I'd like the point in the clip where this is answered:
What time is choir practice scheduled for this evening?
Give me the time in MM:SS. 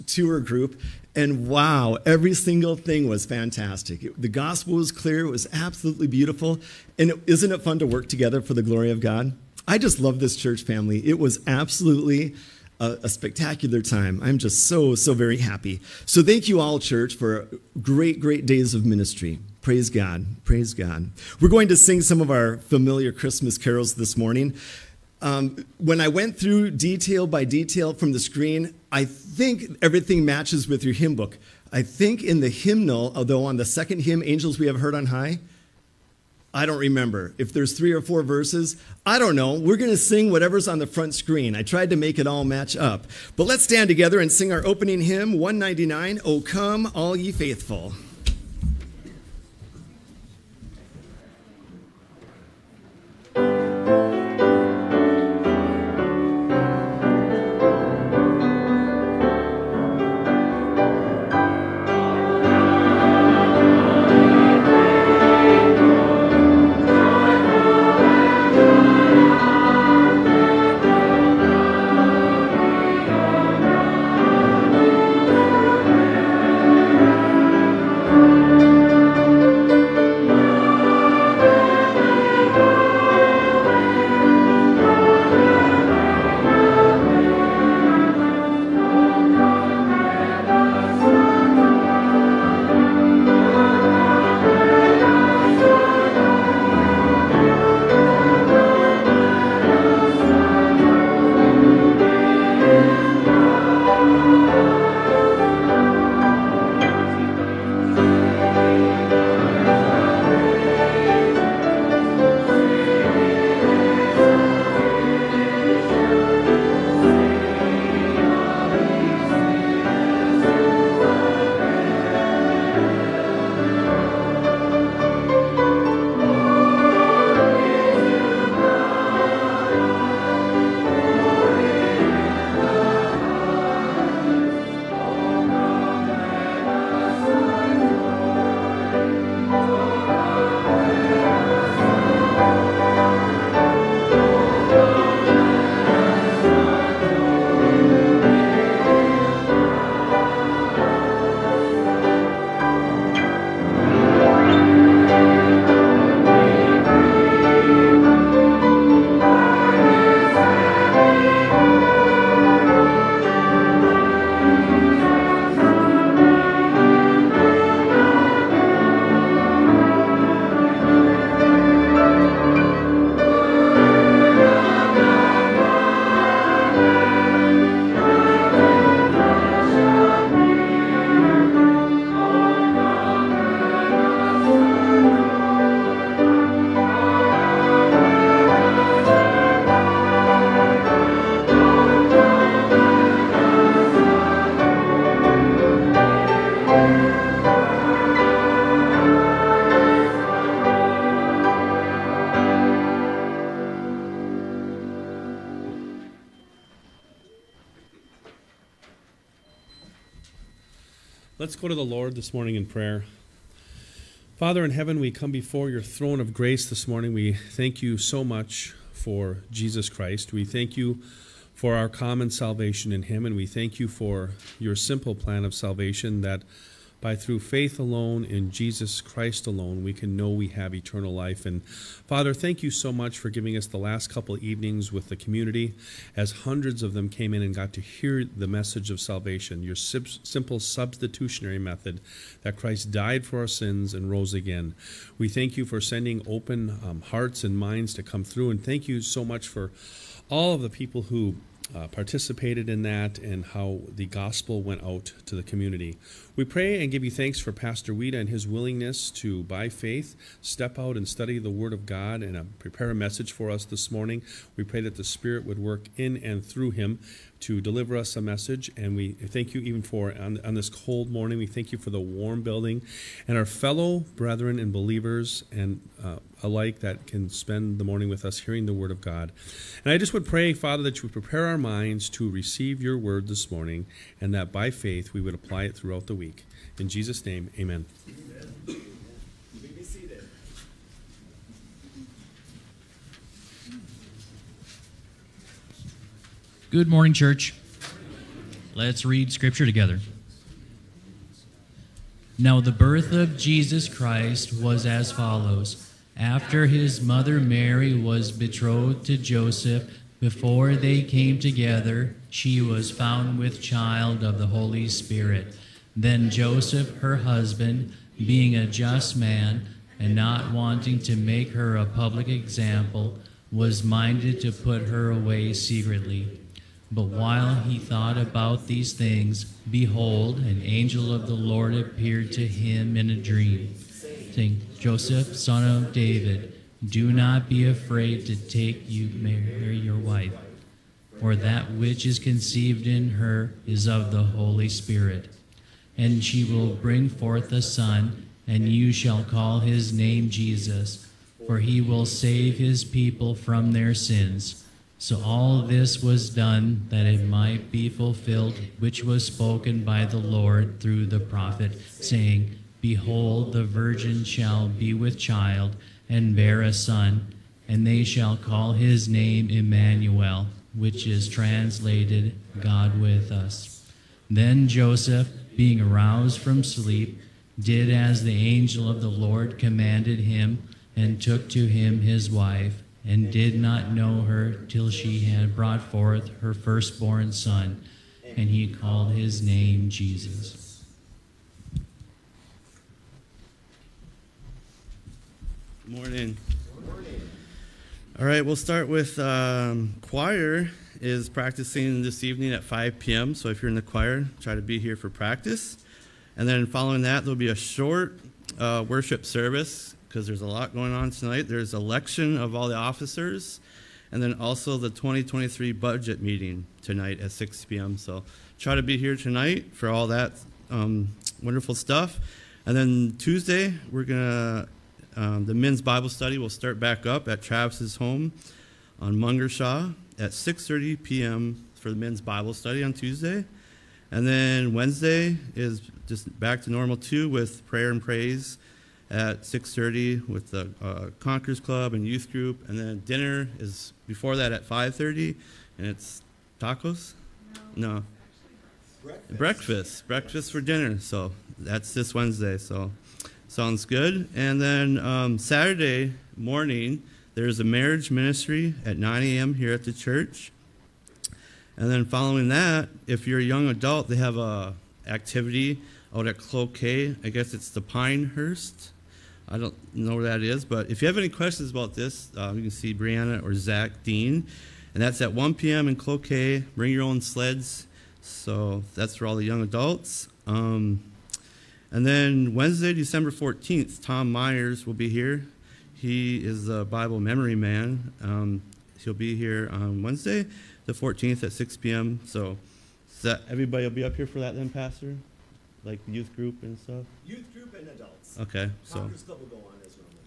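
06:42.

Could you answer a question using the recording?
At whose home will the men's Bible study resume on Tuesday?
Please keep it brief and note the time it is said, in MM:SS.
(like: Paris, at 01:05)
Travis's home, at 07:07.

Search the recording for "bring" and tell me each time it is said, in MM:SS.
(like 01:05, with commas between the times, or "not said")
05:46, 07:56.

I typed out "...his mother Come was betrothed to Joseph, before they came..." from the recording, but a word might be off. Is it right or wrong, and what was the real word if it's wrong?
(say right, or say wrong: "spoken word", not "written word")
wrong: "Mary", not "Come".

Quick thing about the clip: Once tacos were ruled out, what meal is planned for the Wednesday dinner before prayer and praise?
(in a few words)
Breakfast for dinner.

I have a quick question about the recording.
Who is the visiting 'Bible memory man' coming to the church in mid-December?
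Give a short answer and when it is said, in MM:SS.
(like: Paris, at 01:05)
Tom Myers, at 08:04.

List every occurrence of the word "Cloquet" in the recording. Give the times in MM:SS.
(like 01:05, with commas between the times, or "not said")
07:46, 07:55.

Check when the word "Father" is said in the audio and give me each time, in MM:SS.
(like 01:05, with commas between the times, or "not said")
03:34, 03:51, 04:40.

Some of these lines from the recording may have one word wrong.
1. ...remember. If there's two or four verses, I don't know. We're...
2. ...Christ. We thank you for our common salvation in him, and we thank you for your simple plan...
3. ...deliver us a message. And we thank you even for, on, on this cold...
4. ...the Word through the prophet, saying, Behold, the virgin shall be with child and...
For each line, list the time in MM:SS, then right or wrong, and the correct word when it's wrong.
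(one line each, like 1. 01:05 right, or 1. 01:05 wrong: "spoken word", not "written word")
1. 00:36 wrong: "three", not "two"
2. 03:39 right
3. 04:27 right
4. 06:00 wrong: "Lord", not "Word".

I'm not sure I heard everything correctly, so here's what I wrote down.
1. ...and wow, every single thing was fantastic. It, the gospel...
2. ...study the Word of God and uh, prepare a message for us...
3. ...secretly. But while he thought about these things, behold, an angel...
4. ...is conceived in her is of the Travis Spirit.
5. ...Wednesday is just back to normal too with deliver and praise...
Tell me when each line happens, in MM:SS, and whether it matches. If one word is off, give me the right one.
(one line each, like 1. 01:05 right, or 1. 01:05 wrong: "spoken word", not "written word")
1. 00:01 right
2. 04:21 right
3. 05:25 right
4. 05:42 wrong: "Holy", not "Travis"
5. 07:14 wrong: "prayer", not "deliver".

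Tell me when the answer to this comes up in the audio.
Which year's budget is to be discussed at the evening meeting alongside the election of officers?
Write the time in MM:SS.
06:54.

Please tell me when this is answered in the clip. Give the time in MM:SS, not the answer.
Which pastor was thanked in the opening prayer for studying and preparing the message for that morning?
04:17.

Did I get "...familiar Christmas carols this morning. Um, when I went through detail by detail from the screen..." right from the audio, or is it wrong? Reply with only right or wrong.
right.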